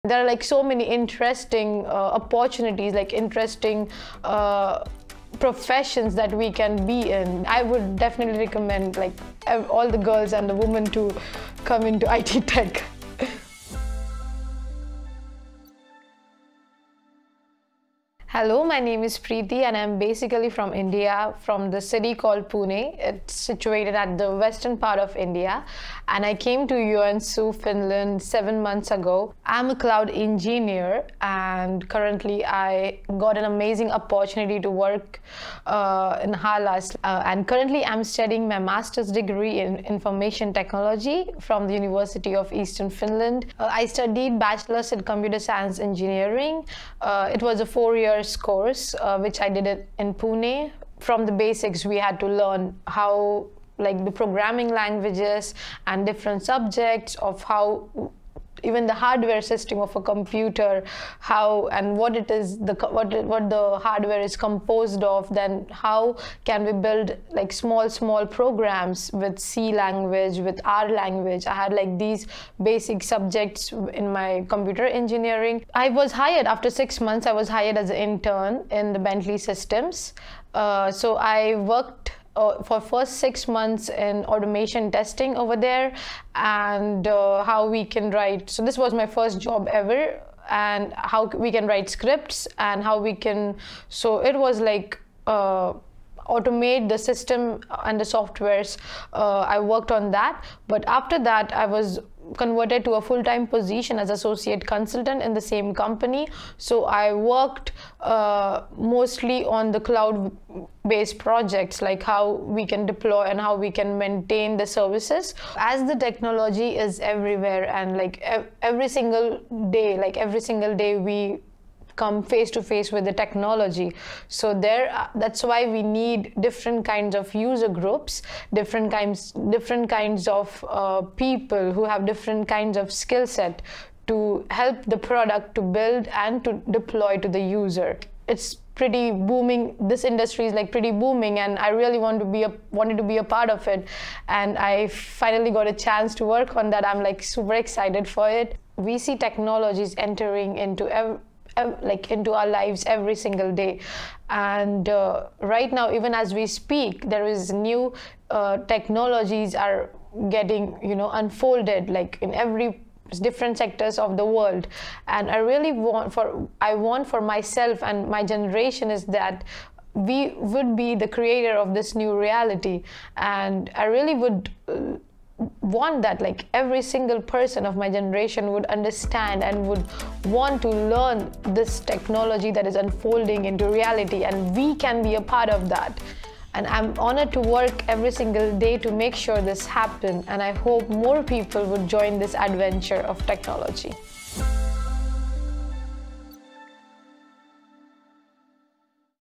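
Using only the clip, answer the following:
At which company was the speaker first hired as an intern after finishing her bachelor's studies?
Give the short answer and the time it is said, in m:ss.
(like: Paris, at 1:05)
Bentley Systems, at 1:18.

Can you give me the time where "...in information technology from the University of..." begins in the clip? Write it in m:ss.
0:39.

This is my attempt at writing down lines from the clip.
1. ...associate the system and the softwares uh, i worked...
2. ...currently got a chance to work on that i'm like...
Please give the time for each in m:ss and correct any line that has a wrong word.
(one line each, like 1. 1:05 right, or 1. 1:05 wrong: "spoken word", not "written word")
1. 1:36 wrong: "automate", not "associate"
2. 2:24 wrong: "finally", not "currently".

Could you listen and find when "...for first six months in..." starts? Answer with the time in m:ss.
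1:22.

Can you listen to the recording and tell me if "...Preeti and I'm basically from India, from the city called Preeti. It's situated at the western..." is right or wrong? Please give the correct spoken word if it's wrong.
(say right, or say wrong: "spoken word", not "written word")
wrong: "Pune", not "Preeti".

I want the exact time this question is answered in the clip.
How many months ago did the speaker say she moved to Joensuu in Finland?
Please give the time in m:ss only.
0:28.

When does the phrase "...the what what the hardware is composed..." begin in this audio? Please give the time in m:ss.
1:02.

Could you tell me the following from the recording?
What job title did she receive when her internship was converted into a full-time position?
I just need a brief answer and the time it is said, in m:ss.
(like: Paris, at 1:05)
Associate consultant, at 1:44.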